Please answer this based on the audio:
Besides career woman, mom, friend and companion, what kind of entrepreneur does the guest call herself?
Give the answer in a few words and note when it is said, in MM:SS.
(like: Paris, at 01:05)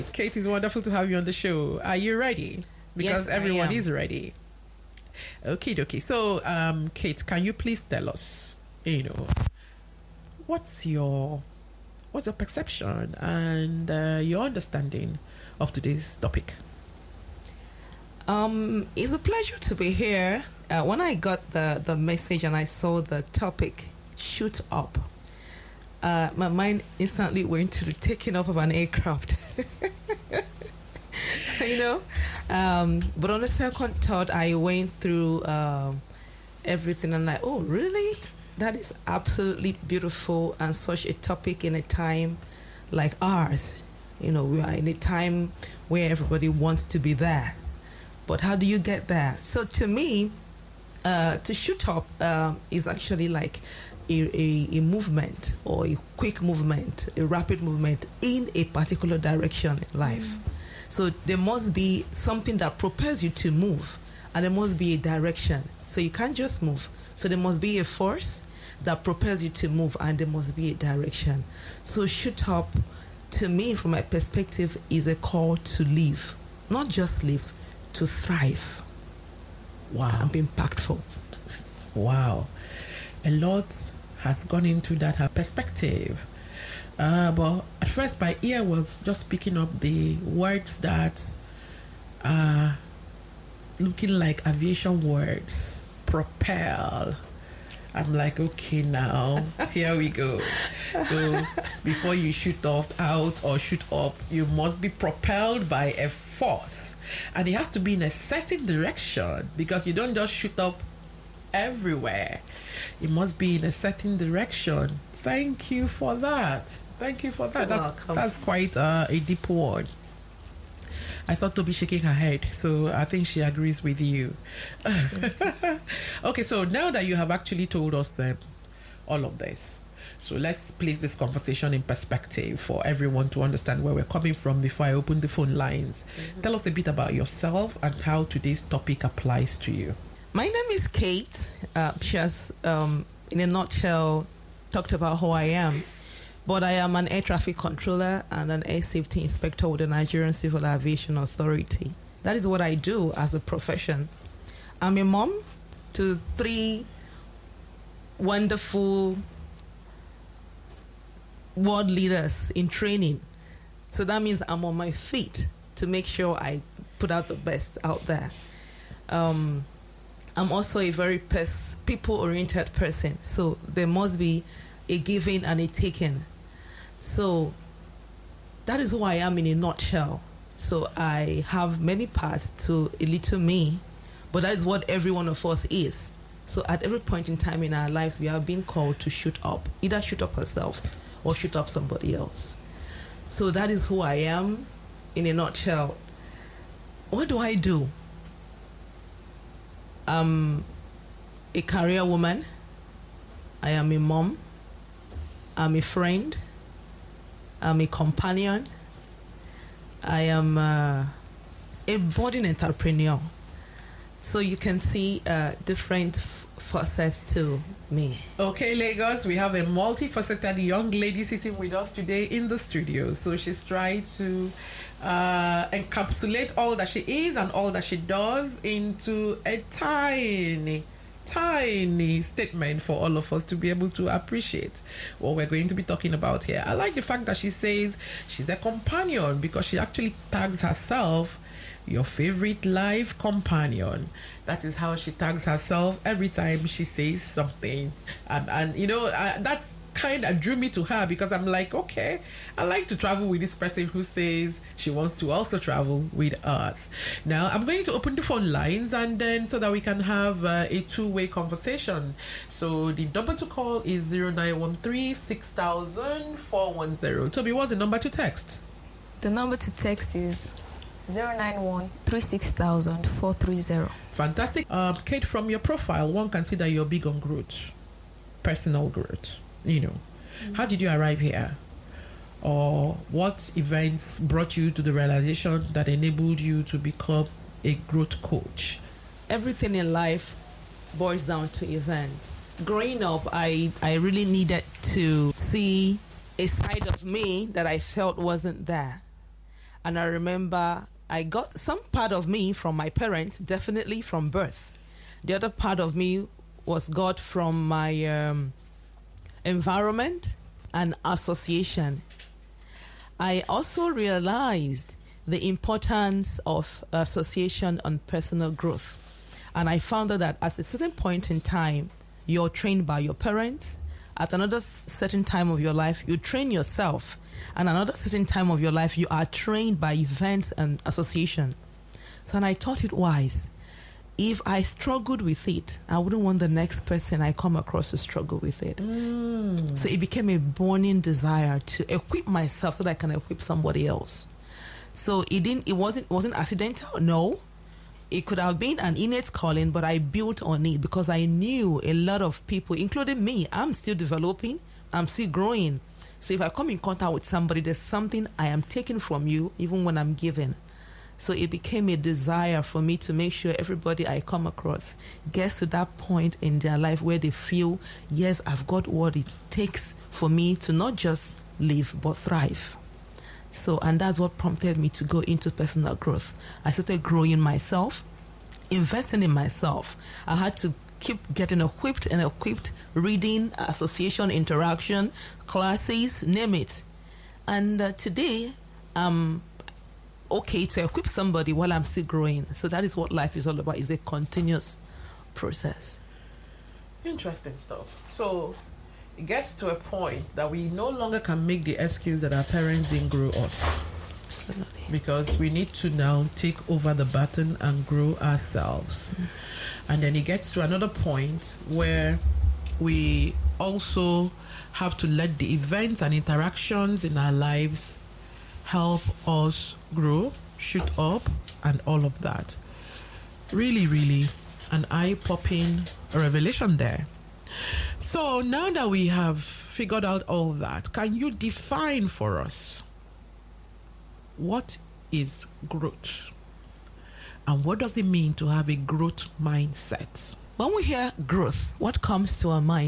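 Budding, at 03:31.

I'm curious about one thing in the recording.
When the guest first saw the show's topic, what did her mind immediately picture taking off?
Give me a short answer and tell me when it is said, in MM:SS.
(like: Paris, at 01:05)
An aircraft, at 00:28.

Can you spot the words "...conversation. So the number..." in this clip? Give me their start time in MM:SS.
04:21.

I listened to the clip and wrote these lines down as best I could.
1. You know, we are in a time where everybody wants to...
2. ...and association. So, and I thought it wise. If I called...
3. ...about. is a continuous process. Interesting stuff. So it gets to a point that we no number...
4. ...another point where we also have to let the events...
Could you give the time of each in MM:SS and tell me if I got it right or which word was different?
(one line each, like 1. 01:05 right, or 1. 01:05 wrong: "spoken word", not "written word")
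1. 00:44 right
2. 05:30 wrong: "struggled", not "called"
3. 06:33 wrong: "longer", not "number"
4. 06:50 right.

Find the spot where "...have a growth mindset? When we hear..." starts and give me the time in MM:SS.
07:18.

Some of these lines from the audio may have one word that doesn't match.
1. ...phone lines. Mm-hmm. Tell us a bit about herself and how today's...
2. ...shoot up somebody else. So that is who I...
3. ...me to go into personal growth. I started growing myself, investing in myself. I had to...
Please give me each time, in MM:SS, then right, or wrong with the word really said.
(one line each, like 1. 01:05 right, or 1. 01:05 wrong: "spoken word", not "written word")
1. 02:15 wrong: "yourself", not "herself"
2. 03:11 right
3. 06:14 right.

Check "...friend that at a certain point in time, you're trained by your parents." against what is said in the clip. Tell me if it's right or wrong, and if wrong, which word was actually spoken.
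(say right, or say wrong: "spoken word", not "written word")
wrong: "found", not "friend".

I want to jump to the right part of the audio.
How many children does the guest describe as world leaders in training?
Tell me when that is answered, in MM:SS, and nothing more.
02:36.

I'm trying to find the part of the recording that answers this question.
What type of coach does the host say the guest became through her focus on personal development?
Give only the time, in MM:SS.
04:47.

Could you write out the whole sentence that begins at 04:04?
That is how she tags herself every time she says something.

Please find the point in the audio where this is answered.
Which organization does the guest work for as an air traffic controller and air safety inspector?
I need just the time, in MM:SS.
02:29.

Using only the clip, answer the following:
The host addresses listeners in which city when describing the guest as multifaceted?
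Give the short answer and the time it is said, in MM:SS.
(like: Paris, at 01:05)
Lagos, at 03:38.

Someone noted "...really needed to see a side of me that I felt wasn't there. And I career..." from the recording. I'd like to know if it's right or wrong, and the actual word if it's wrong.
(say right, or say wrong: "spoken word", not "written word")
wrong: "remember", not "career".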